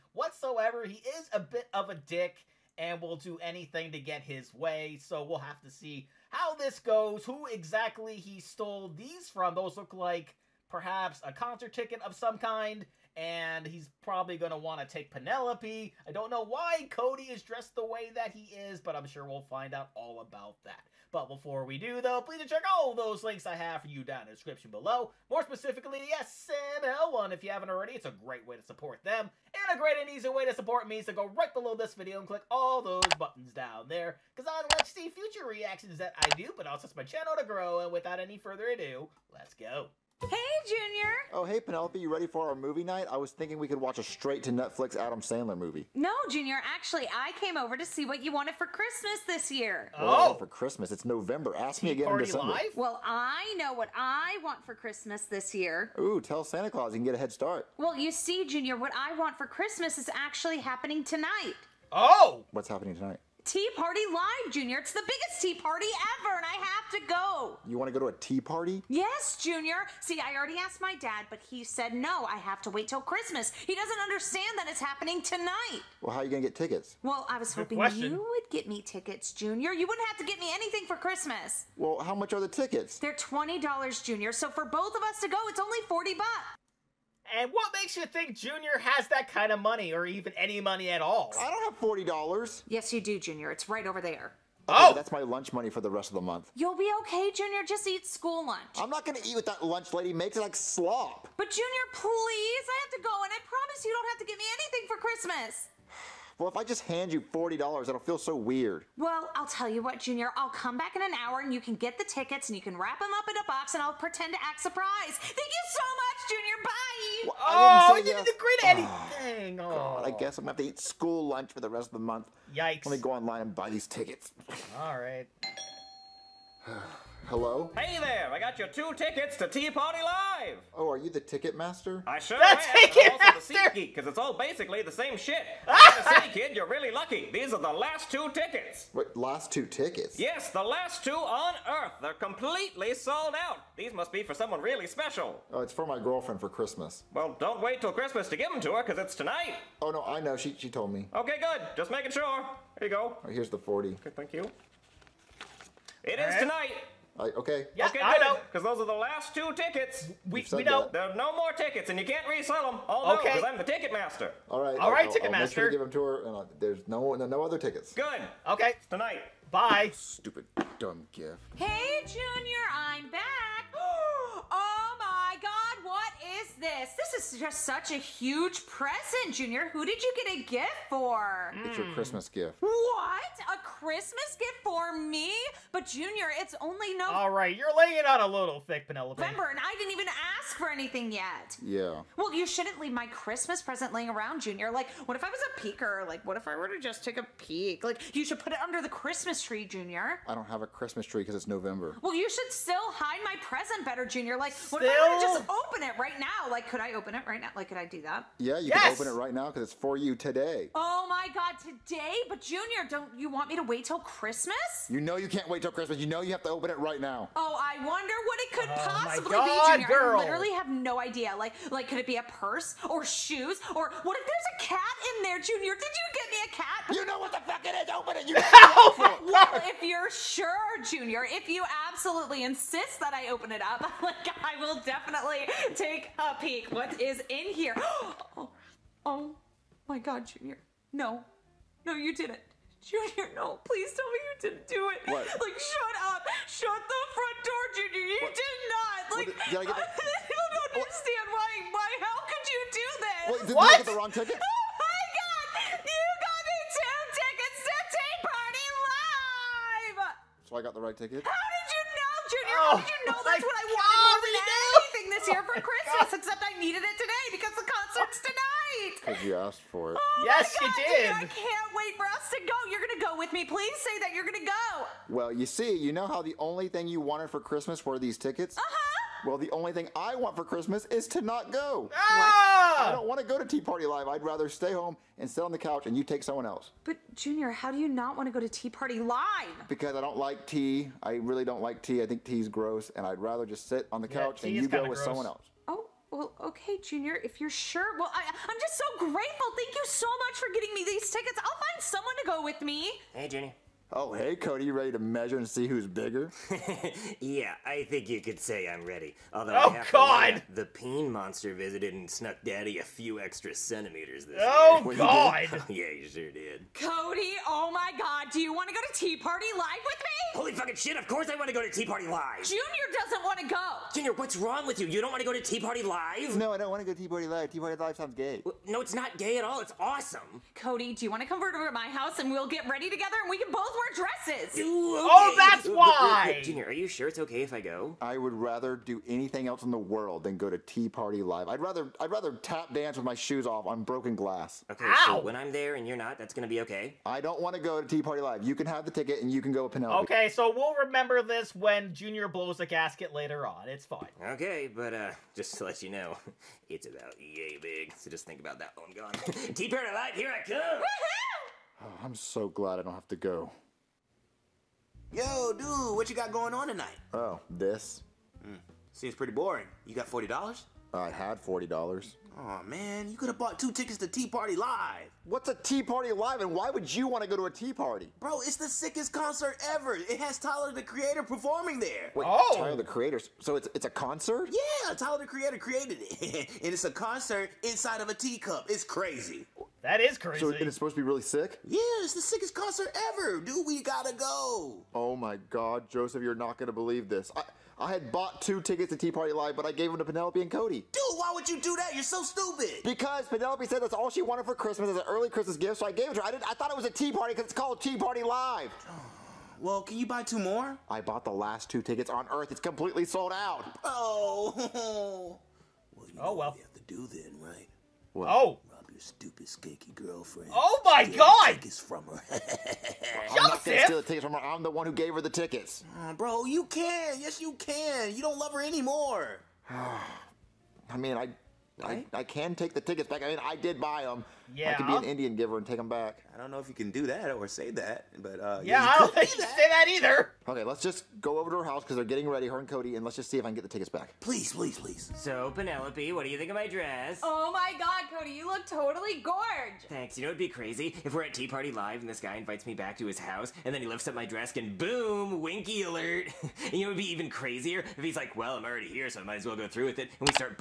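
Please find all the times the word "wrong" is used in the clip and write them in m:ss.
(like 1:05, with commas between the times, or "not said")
4:13, 5:24.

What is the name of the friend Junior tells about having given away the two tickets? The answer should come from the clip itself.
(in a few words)
Joseph.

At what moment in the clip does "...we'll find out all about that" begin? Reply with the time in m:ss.
0:19.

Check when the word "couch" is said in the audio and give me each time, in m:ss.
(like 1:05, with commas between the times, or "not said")
4:45, 4:54.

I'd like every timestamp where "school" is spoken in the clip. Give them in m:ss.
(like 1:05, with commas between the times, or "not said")
1:38, 2:00.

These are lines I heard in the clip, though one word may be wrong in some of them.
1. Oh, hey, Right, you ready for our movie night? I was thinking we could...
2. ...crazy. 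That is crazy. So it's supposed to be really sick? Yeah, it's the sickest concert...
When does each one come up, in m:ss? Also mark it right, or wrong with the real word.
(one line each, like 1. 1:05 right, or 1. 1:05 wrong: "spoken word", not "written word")
1. 0:41 wrong: "Penelope", not "Right"
2. 6:28 right.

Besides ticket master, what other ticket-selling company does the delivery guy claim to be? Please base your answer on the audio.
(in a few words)
Seat geek.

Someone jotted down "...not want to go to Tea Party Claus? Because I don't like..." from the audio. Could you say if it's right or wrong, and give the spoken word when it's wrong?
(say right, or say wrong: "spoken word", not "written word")
wrong: "Live", not "Claus".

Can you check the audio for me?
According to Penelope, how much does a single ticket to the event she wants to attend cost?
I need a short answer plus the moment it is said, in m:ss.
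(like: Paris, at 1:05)
$20, at 1:23.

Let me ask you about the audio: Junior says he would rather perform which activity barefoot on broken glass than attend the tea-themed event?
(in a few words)
Tap dance.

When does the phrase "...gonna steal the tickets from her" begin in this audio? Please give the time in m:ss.
7:03.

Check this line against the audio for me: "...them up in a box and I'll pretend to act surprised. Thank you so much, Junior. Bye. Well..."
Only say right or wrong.
right.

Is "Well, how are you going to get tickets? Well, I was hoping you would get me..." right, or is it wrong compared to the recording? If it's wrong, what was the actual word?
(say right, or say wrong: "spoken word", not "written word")
right.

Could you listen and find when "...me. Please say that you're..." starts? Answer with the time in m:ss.
4:33.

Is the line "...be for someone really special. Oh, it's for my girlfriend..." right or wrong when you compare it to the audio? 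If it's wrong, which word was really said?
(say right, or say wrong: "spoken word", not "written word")
right.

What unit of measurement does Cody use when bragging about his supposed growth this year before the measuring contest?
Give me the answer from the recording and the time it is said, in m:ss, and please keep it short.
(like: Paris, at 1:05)
Centimeters, at 5:13.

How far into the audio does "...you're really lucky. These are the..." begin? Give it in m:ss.
2:16.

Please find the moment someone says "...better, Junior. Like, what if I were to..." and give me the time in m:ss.
3:23.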